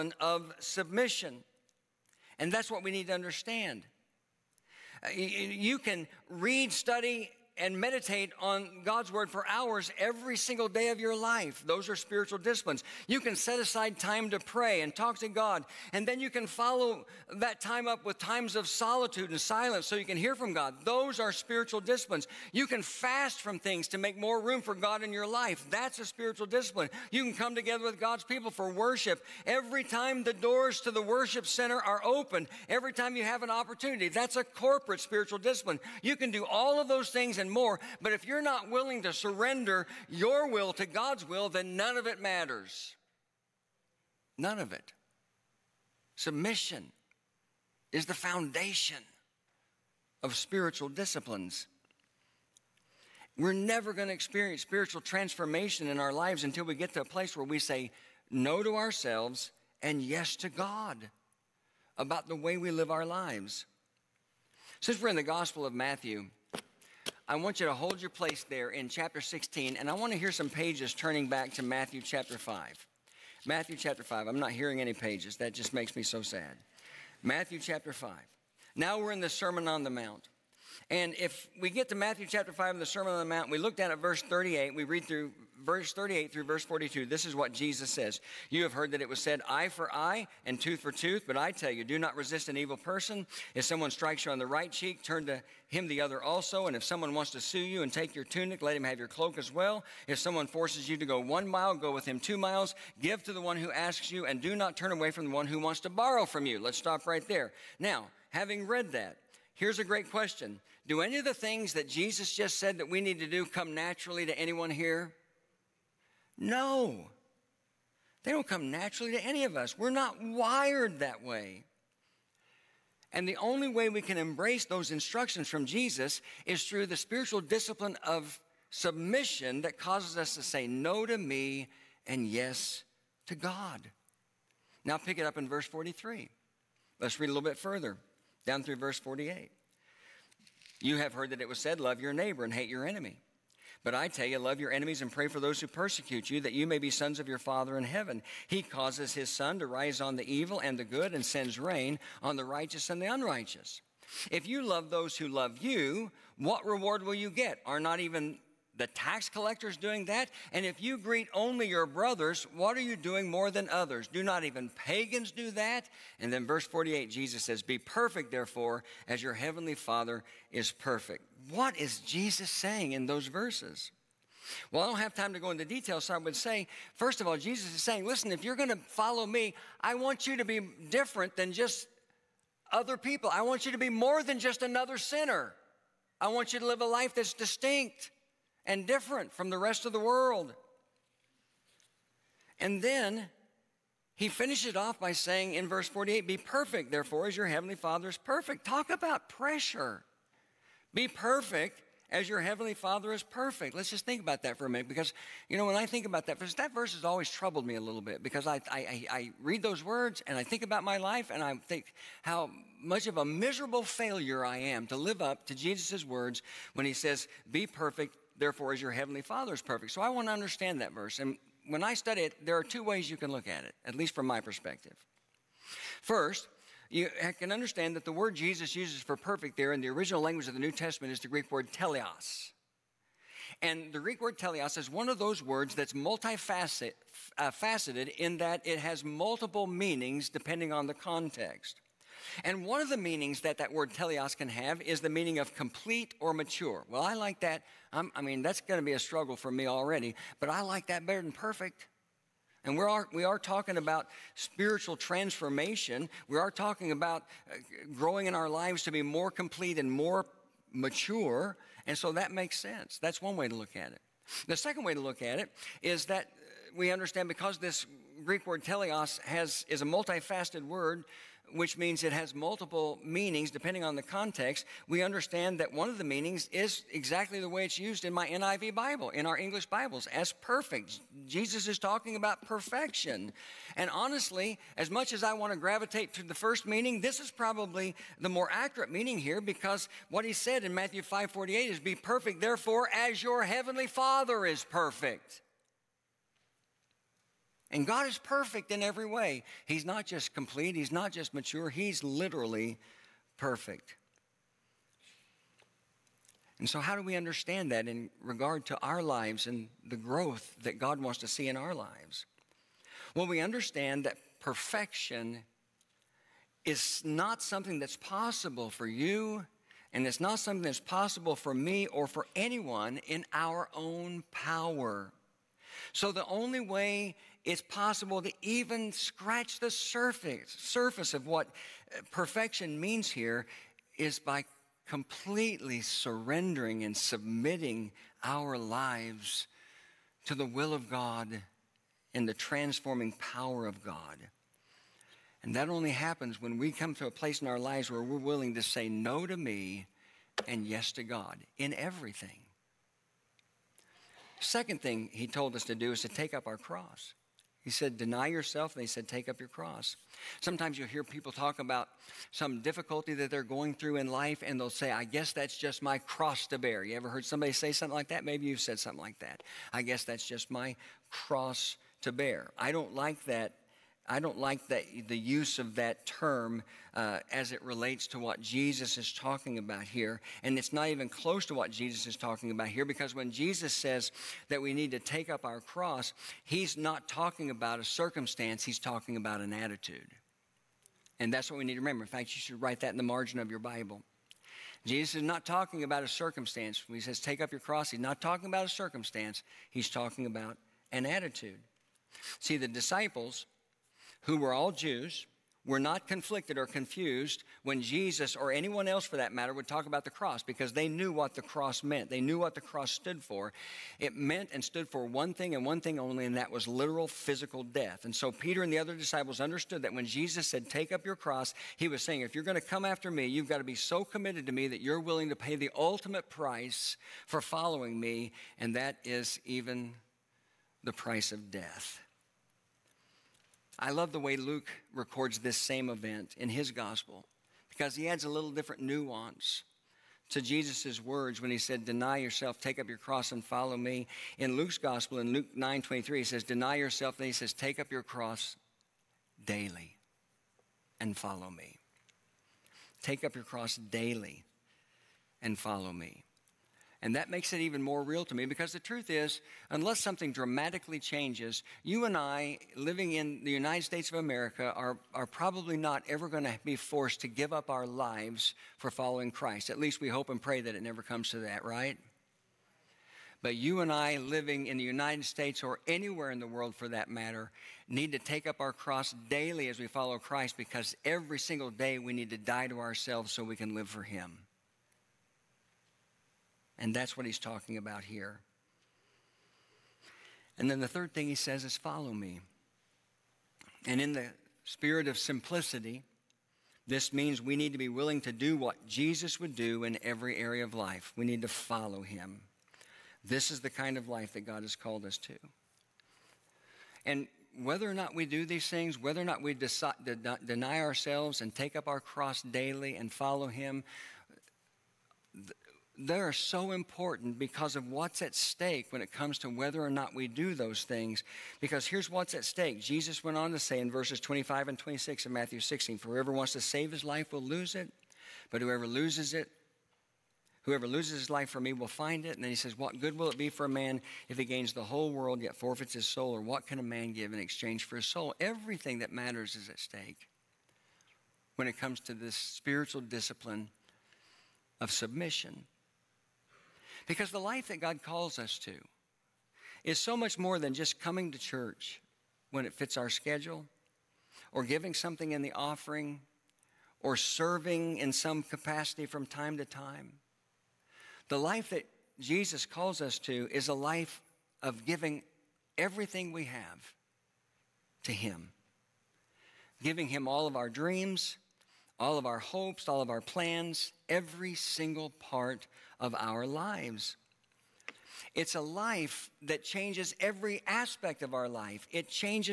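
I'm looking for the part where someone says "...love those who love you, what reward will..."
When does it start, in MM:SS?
02:34.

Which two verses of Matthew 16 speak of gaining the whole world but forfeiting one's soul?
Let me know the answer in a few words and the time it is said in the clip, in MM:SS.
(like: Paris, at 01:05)
25 and 26, at 08:44.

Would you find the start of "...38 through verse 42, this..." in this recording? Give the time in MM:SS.
01:25.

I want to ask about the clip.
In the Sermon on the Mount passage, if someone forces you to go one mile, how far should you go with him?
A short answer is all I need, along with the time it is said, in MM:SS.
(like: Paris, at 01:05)
2 miles, at 01:42.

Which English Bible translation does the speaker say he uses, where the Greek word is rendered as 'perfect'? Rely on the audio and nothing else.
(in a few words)
NIV.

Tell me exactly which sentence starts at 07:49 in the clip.
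At least we hope and pray that it never comes to that, right?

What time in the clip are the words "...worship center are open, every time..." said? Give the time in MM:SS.
00:31.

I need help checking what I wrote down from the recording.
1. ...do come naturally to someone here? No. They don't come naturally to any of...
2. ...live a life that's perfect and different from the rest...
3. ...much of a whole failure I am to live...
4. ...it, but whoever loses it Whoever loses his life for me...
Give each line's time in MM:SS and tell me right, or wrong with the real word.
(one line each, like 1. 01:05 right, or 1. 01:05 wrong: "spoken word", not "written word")
1. 01:53 wrong: "anyone", not "someone"
2. 03:06 wrong: "distinct", not "perfect"
3. 03:32 wrong: "miserable", not "whole"
4. 08:47 right.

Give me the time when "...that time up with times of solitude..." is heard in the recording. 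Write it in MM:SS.
00:17.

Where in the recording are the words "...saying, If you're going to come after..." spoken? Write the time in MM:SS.
07:02.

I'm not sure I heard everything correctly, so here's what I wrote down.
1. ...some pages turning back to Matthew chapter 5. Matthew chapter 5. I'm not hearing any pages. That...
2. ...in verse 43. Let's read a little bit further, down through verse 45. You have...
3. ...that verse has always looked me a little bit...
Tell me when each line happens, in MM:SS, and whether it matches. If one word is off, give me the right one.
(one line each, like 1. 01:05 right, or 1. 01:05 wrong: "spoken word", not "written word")
1. 01:10 right
2. 02:15 wrong: "48", not "45"
3. 03:26 wrong: "troubled", not "looked".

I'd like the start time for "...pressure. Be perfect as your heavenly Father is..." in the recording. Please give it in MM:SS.
03:19.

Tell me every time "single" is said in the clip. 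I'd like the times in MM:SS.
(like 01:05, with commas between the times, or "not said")
00:10, 08:01, 09:34.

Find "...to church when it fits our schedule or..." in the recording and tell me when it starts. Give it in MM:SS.
09:11.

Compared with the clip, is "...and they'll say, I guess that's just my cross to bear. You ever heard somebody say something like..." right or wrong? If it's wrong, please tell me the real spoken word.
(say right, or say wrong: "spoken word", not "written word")
right.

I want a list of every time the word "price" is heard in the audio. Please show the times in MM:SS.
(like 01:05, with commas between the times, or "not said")
07:06, 07:10.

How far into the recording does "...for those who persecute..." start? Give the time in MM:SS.
02:25.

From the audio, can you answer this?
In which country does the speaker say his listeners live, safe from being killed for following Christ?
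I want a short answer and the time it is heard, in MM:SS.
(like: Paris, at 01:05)
United States of America, at 07:43.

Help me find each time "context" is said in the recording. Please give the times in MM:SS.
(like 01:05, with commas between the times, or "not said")
04:00, 04:34.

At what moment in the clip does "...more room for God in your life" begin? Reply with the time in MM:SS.
00:24.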